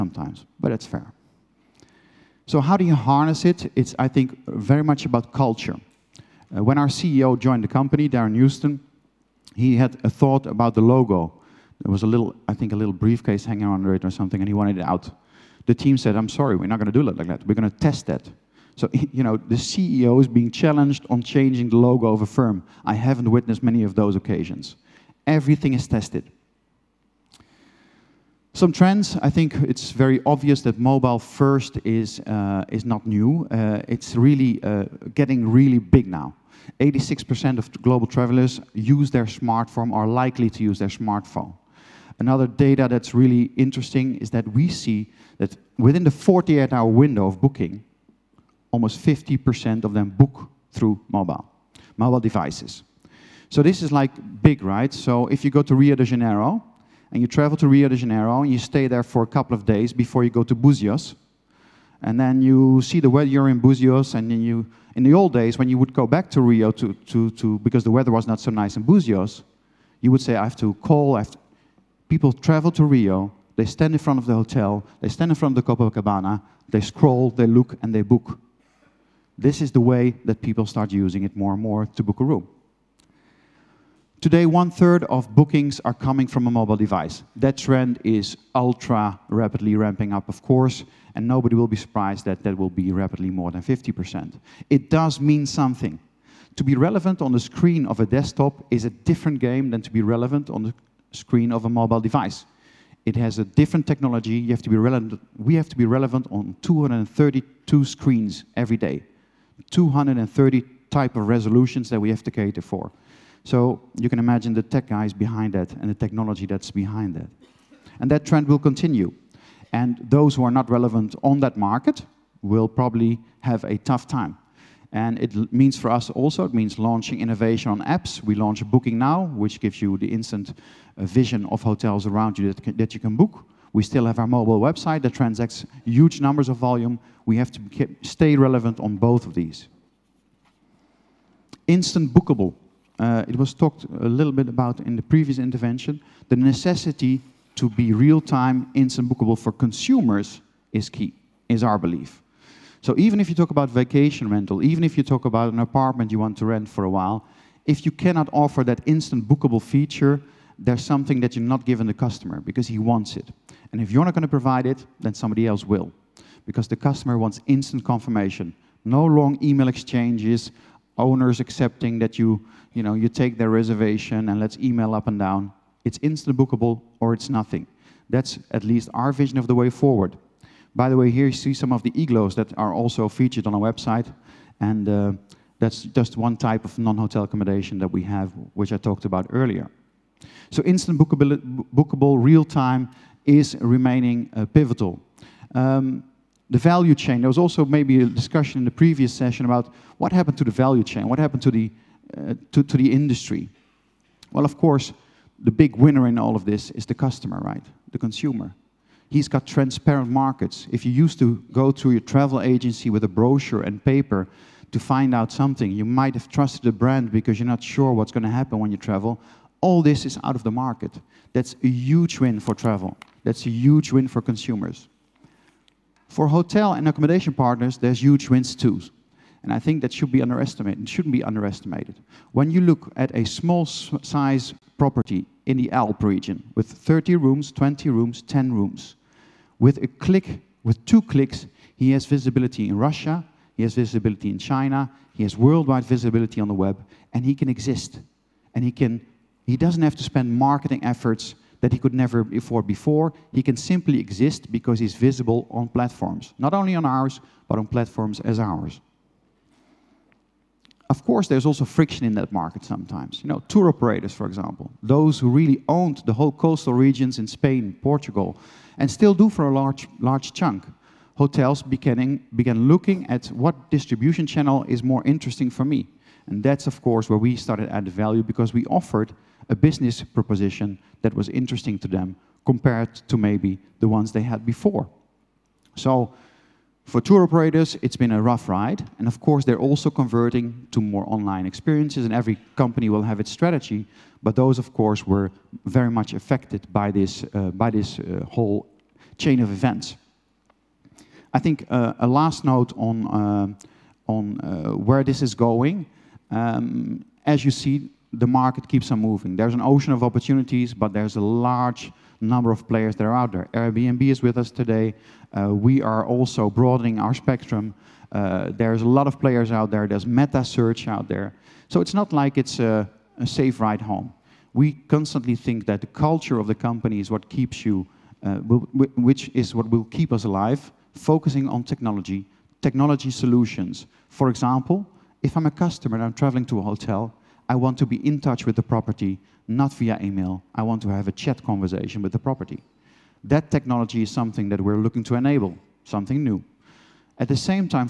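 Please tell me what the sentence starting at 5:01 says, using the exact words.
I think uh, a last note on, uh, on uh, where this is going.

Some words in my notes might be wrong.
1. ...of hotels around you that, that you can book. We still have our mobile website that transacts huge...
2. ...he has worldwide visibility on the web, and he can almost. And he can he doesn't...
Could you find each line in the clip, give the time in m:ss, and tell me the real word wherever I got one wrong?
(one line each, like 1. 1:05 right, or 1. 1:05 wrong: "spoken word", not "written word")
1. 2:11 right
2. 4:05 wrong: "exist", not "almost".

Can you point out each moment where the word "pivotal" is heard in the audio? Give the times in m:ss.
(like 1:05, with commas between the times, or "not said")
3:14.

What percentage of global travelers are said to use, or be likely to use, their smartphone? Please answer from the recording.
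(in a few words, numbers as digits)
86%.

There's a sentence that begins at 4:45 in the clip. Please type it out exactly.
So for tour operators, it's been a rough ride.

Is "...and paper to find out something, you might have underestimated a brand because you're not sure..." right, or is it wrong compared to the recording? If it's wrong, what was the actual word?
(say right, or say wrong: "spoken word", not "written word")
wrong: "trusted", not "underestimated".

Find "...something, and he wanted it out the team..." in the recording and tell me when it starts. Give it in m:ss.
0:14.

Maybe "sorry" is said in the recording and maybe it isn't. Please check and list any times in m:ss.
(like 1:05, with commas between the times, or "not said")
0:16.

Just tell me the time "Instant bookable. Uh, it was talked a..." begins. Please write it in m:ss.
2:21.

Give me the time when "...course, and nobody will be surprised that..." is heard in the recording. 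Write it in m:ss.
1:30.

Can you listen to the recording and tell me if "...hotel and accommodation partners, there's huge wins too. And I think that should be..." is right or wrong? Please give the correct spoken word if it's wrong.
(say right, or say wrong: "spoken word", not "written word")
right.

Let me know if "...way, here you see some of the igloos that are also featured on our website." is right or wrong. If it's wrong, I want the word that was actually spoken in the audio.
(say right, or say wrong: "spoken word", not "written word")
right.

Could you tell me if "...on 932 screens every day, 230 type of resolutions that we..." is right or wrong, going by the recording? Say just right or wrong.
wrong.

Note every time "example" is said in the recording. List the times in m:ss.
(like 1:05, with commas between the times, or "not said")
4:24, 5:34.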